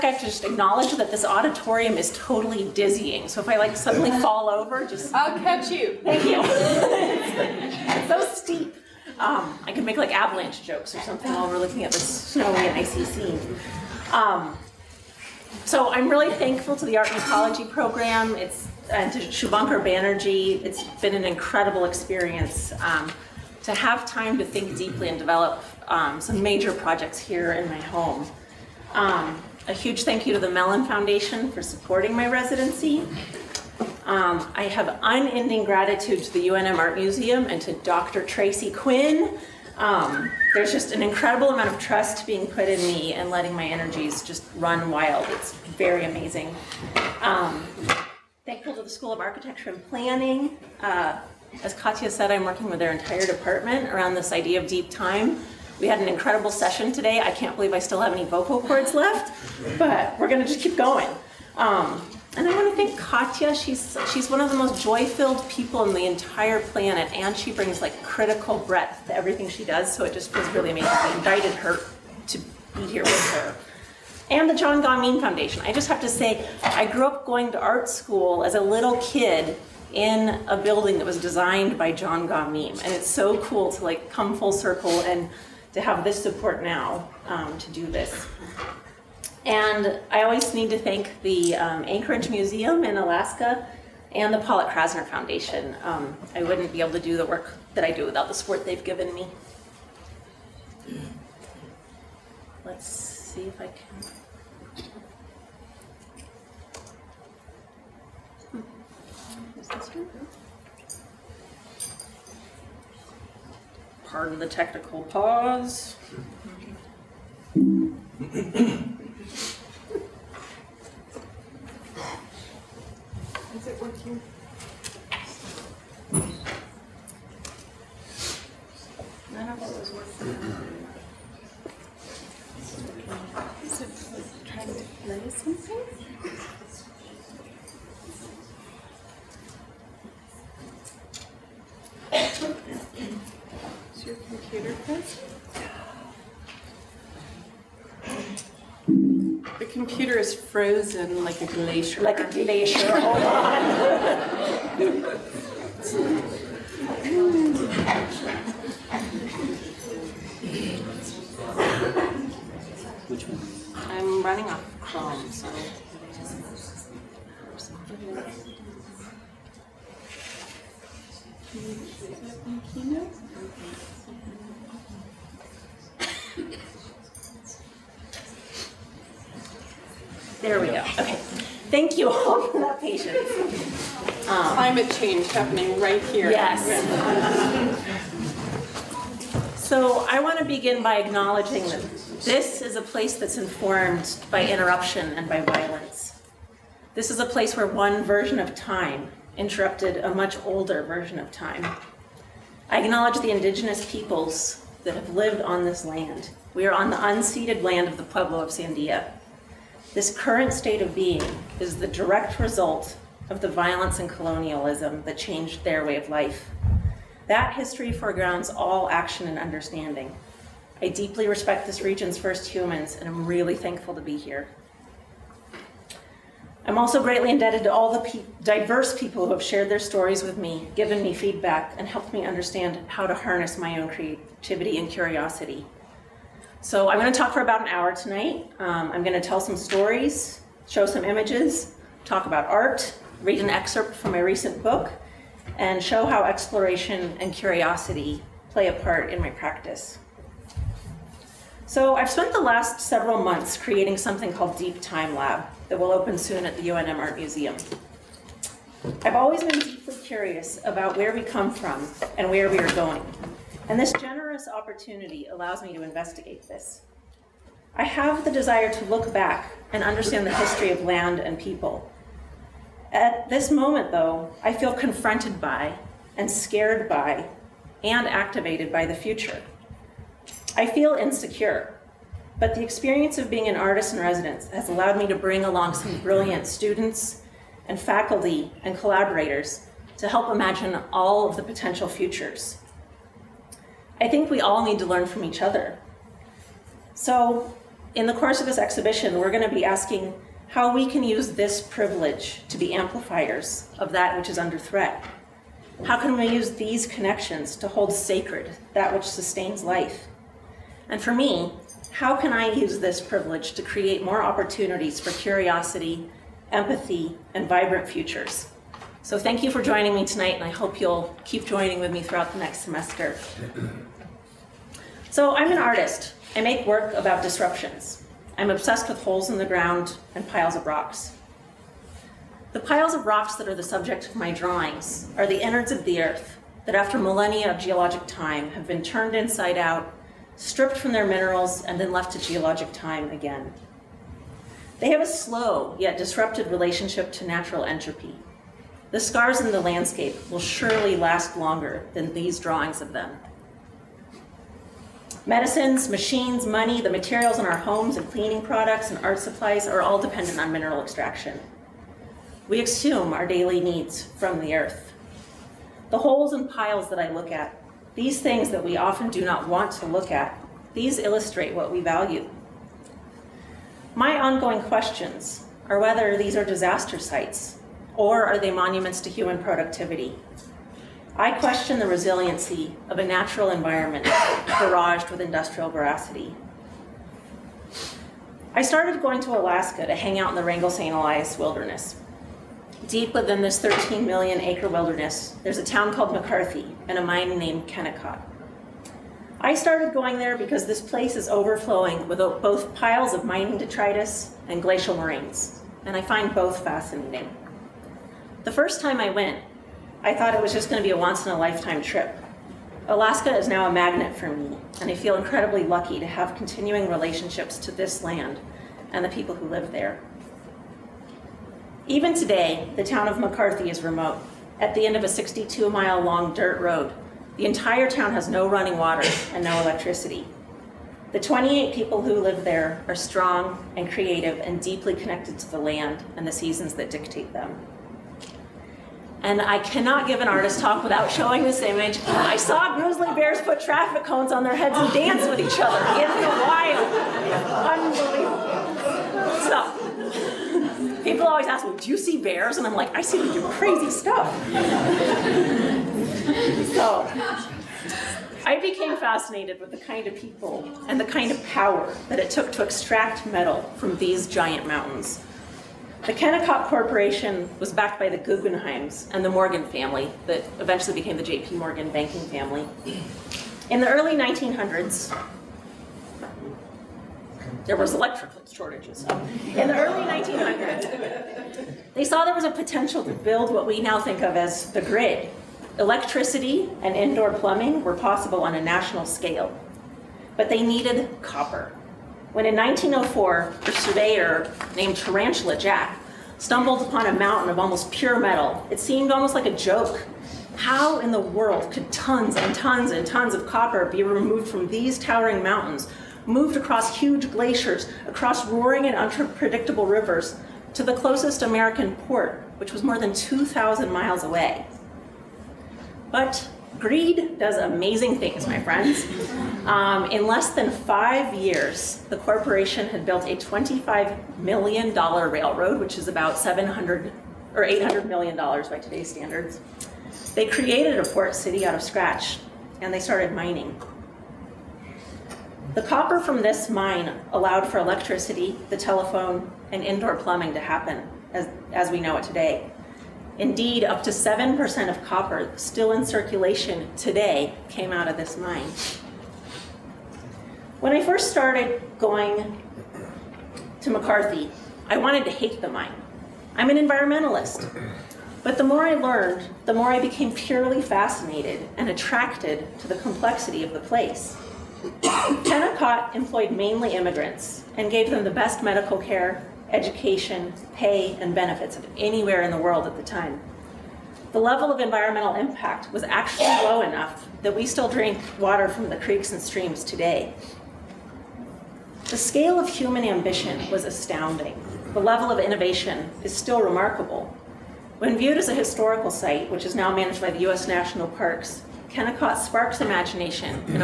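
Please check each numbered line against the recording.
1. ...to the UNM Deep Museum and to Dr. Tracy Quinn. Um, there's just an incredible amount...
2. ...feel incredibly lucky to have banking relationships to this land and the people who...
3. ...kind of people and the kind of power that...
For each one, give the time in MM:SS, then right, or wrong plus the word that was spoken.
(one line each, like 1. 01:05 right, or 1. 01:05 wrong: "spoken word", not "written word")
1. 00:36 wrong: "Art", not "Deep"
2. 06:54 wrong: "continuing", not "banking"
3. 07:39 right.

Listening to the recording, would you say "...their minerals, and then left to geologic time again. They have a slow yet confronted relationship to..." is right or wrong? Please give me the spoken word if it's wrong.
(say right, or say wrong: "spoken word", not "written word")
wrong: "disrupted", not "confronted".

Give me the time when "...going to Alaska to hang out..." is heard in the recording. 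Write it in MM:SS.
06:29.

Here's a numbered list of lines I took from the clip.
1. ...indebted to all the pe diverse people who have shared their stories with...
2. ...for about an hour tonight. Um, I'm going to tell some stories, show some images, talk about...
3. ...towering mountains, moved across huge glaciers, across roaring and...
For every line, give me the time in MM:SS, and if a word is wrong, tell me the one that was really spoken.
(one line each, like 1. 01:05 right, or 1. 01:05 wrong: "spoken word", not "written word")
1. 03:47 right
2. 03:57 right
3. 08:24 right.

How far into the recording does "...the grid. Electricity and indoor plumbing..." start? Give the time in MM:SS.
08:04.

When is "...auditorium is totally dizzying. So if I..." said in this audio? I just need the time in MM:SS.
00:01.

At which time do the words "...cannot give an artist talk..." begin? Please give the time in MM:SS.
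07:19.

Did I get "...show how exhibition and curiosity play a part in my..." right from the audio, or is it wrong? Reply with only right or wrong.
wrong.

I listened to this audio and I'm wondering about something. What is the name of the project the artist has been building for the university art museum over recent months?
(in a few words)
Deep Time Lab.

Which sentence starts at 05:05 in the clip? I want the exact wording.
How can we use these connections to hold sacred that which sustains life?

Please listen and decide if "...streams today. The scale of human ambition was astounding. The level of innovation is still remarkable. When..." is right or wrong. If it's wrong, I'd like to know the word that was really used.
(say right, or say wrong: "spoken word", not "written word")
right.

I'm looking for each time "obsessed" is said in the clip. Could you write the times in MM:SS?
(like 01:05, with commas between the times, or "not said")
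05:28.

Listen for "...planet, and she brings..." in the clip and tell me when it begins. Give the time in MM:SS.
01:06.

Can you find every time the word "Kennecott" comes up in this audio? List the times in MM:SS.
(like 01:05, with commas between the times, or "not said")
06:37, 07:46, 09:25, 09:51.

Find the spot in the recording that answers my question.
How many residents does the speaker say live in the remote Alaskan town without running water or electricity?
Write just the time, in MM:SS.
07:11.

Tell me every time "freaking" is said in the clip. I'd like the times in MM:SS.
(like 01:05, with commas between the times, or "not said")
not said.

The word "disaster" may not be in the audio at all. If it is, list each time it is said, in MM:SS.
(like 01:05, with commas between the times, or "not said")
06:16.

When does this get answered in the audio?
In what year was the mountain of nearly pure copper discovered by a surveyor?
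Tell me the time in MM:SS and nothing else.
08:12.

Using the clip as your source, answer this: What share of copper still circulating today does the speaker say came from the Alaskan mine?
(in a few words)
7%.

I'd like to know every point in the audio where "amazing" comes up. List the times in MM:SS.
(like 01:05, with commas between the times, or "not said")
00:46, 01:10, 08:37.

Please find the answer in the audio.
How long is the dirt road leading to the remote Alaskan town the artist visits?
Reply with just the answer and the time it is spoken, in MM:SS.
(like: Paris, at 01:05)
62 miles, at 07:05.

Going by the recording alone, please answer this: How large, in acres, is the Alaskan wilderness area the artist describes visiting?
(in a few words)
13 million acres.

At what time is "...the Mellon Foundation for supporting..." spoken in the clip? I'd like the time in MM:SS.
00:30.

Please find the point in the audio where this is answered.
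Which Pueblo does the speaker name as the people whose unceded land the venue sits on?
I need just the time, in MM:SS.
03:28.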